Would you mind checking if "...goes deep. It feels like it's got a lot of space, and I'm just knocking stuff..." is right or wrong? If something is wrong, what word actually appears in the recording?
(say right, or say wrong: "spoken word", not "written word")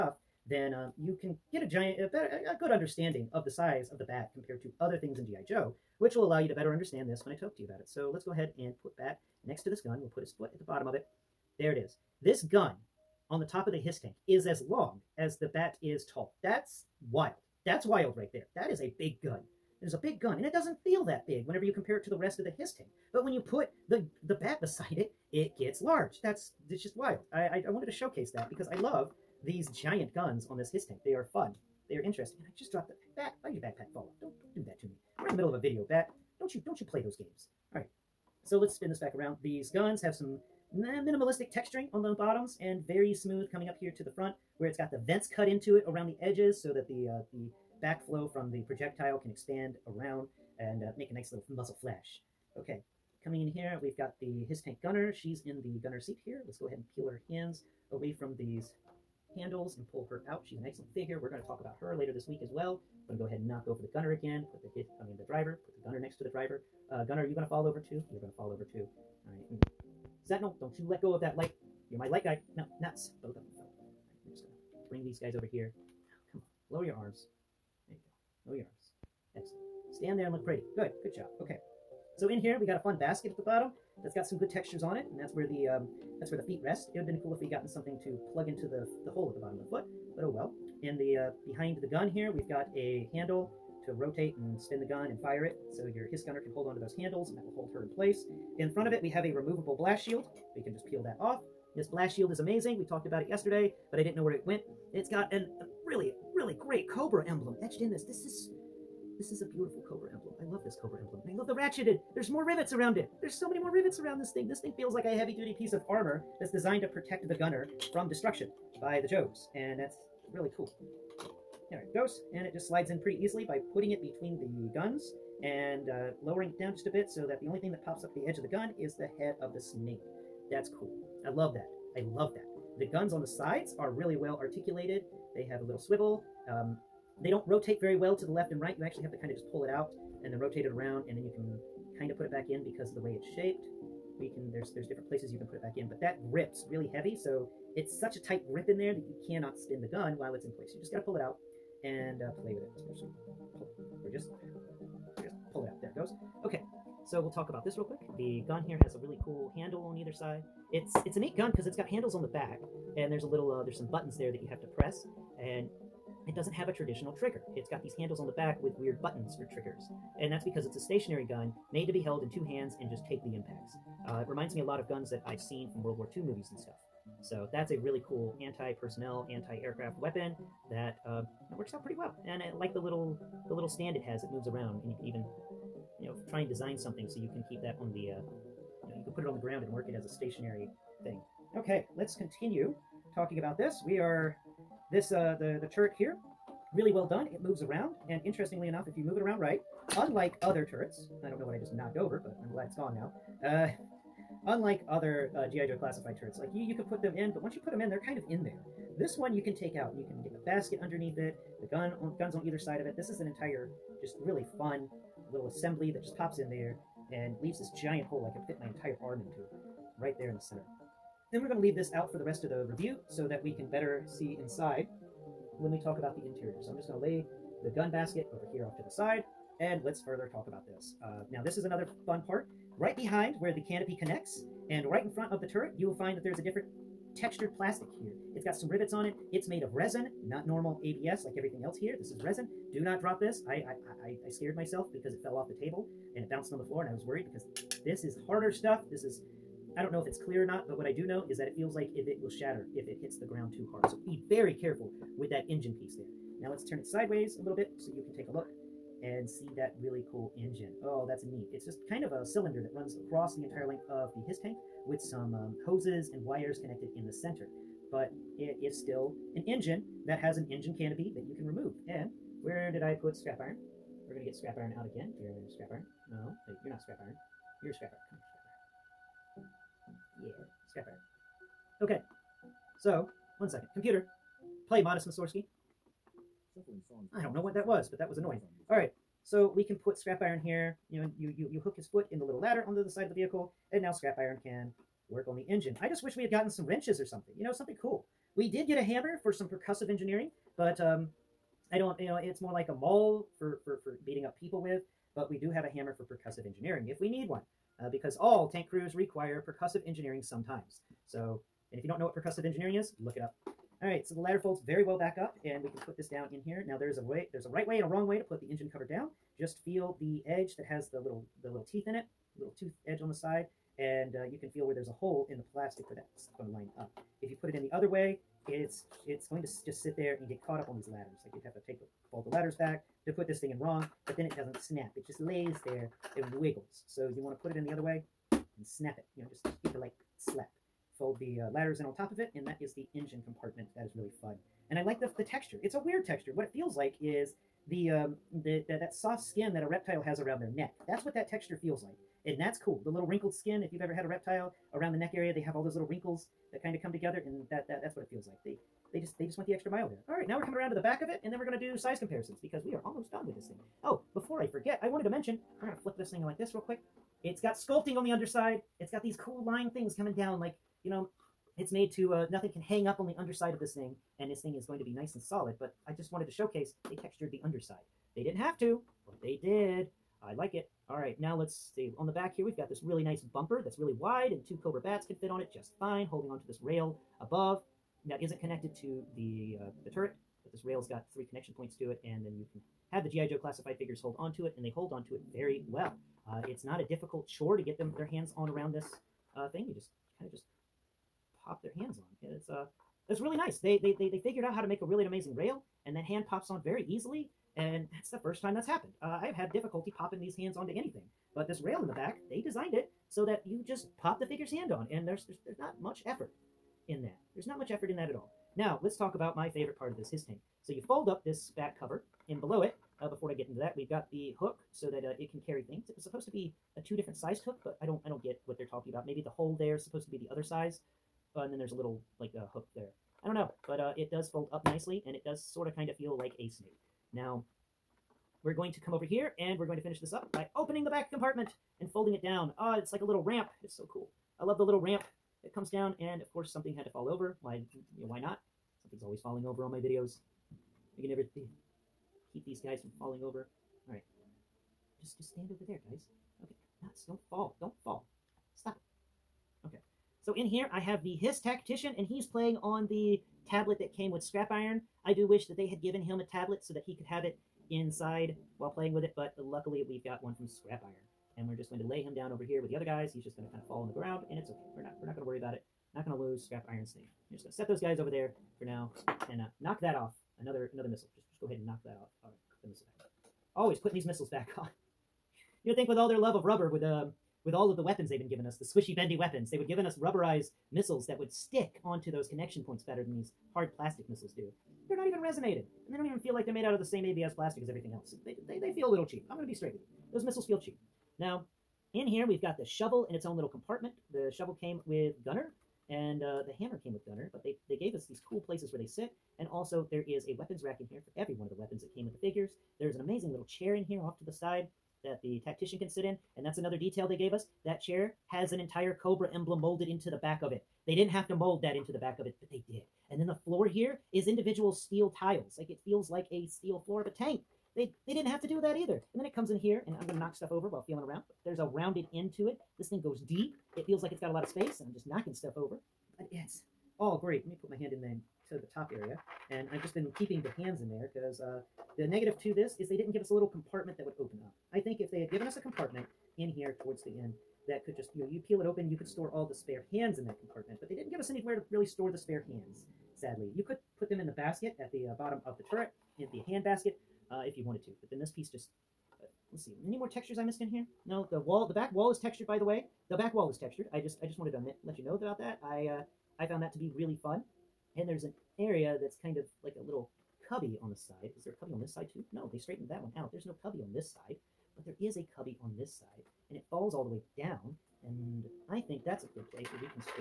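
right.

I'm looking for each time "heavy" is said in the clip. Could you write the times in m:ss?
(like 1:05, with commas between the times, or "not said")
1:55, 2:26.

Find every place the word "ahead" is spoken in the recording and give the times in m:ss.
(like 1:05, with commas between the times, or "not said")
0:08, 0:56, 1:03, 8:01.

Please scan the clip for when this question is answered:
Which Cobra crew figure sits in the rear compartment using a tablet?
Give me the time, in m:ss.
7:41.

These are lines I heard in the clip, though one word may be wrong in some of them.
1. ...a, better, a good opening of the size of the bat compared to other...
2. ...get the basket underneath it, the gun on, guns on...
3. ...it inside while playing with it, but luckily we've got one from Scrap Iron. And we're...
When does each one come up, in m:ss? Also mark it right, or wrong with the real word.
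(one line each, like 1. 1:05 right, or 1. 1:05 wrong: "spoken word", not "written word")
1. 0:02 wrong: "understanding", not "opening"
2. 3:30 right
3. 7:47 right.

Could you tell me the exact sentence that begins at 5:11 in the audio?
So, and if you don't know what percussive engineering is, look it up.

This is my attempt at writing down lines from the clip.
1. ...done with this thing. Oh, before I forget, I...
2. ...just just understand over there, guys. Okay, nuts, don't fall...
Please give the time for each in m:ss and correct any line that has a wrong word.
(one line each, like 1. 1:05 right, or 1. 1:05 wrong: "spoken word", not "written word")
1. 6:03 right
2. 7:35 wrong: "stand", not "understand".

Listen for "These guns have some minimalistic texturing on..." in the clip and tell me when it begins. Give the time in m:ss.
0:39.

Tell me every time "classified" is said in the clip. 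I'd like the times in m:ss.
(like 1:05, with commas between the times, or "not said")
3:25, 6:33.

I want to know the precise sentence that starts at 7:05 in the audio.
It was supposed to be a two different sized hook, but I don't I don't get what they're talking about.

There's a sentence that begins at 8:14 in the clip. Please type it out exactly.
They're not even resonated, and they don't even feel like they're made out of the same ABS plastic as everything else.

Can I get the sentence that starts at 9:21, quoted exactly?
No, the wall, the back wall is textured, by the way.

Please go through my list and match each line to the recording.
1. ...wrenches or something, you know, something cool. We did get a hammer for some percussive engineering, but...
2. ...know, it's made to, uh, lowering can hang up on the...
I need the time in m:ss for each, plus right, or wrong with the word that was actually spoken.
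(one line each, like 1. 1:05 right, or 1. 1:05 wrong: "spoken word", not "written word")
1. 4:56 right
2. 6:10 wrong: "nothing", not "lowering".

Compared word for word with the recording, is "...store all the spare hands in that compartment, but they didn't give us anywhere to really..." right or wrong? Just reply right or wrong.
right.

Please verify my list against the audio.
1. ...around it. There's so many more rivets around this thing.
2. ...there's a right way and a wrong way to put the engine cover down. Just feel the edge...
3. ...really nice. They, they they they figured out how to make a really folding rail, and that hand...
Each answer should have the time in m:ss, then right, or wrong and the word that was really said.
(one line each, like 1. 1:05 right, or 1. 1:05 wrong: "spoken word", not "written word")
1. 1:52 right
2. 5:17 right
3. 6:43 wrong: "amazing", not "folding".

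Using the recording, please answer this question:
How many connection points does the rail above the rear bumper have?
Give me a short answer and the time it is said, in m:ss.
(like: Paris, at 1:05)
3, at 6:31.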